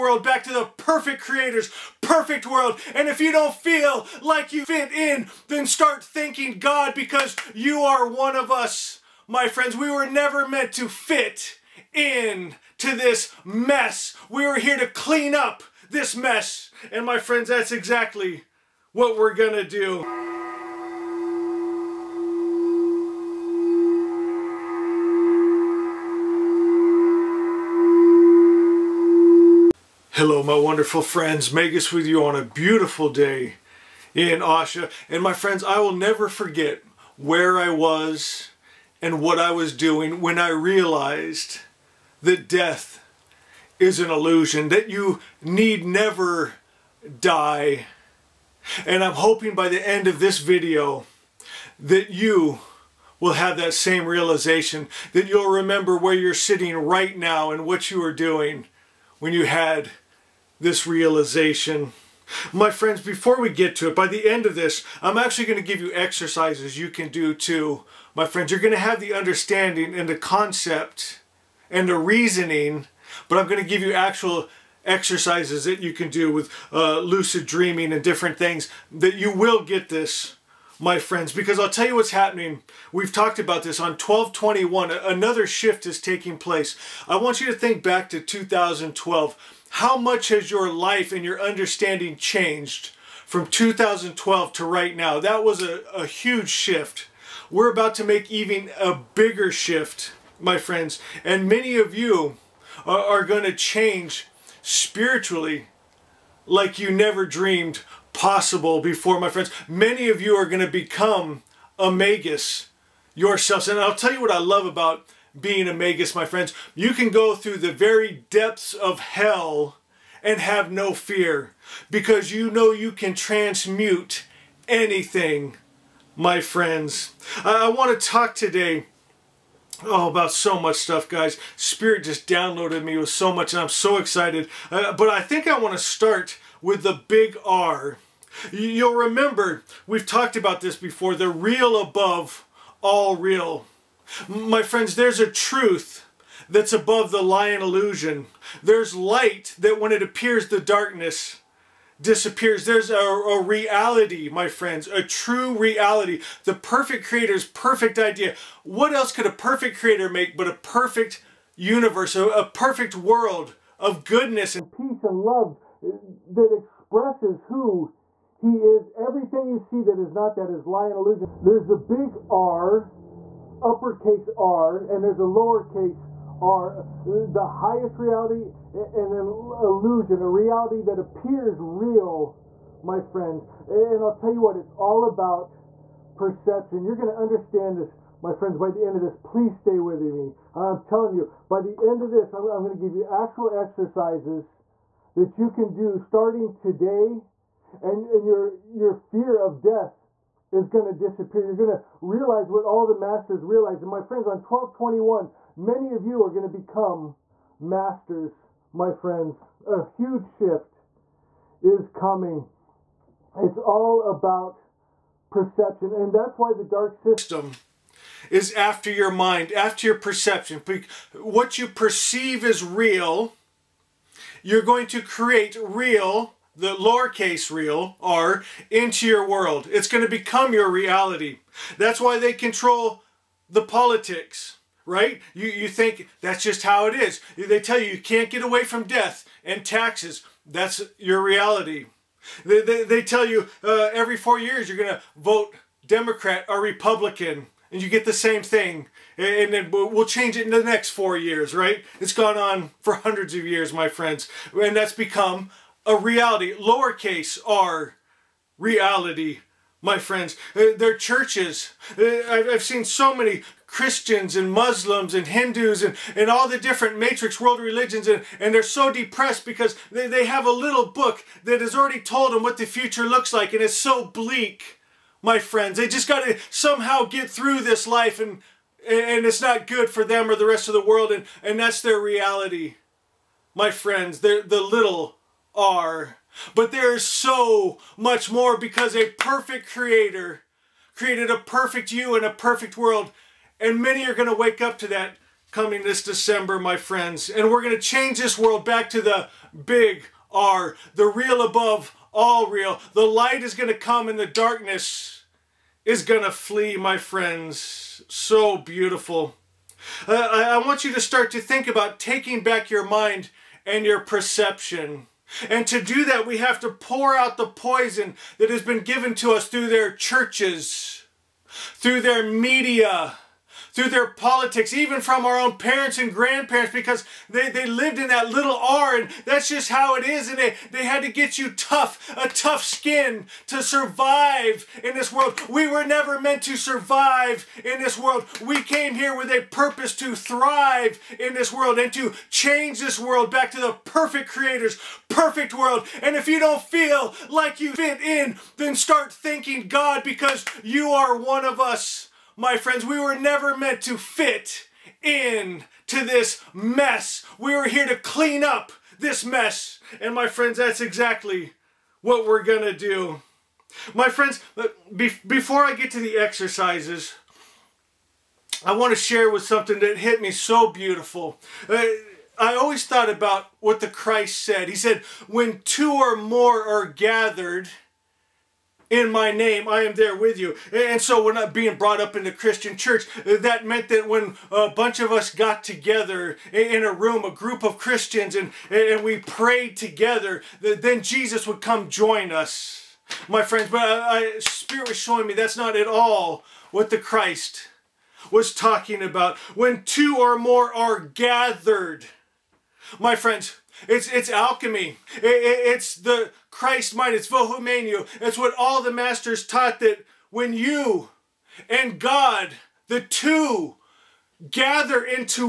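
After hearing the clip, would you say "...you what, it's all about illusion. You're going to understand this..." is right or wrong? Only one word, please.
wrong.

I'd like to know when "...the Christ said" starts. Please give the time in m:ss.
6:13.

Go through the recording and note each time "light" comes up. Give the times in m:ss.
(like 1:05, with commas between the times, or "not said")
2:28, 5:03.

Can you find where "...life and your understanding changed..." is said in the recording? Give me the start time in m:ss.
1:30.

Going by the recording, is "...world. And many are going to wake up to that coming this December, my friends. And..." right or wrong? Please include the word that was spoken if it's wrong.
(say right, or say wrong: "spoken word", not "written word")
right.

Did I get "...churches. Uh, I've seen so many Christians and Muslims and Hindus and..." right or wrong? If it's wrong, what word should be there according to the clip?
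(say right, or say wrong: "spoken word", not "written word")
right.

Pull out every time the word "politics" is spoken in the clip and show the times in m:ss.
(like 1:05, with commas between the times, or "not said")
3:53, 5:24.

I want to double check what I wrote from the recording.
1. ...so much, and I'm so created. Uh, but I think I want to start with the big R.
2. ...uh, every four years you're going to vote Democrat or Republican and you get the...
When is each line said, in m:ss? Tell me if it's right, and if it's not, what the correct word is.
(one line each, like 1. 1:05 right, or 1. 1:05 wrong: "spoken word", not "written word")
1. 2:13 wrong: "excited", not "created"
2. 4:03 right.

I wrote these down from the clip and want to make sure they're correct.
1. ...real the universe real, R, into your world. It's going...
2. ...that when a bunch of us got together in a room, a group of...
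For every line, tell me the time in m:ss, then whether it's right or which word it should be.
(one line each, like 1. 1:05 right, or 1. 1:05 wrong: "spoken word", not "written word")
1. 3:45 wrong: "lowercase", not "universe"
2. 6:23 right.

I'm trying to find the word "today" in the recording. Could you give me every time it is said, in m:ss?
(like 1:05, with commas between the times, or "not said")
2:08, 3:16.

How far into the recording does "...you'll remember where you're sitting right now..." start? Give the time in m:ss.
0:55.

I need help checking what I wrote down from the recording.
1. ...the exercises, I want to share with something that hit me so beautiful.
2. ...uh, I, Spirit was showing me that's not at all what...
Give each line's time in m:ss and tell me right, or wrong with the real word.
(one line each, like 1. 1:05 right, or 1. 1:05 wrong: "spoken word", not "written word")
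1. 6:05 right
2. 6:33 right.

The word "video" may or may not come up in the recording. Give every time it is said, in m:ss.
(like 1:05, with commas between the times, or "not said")
0:50.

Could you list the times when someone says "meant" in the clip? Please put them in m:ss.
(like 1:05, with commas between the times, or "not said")
0:10, 5:36, 5:53, 6:23.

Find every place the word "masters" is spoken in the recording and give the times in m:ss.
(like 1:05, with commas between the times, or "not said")
3:22, 3:27, 6:48.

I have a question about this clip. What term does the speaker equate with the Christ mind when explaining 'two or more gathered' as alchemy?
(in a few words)
Vohumenu.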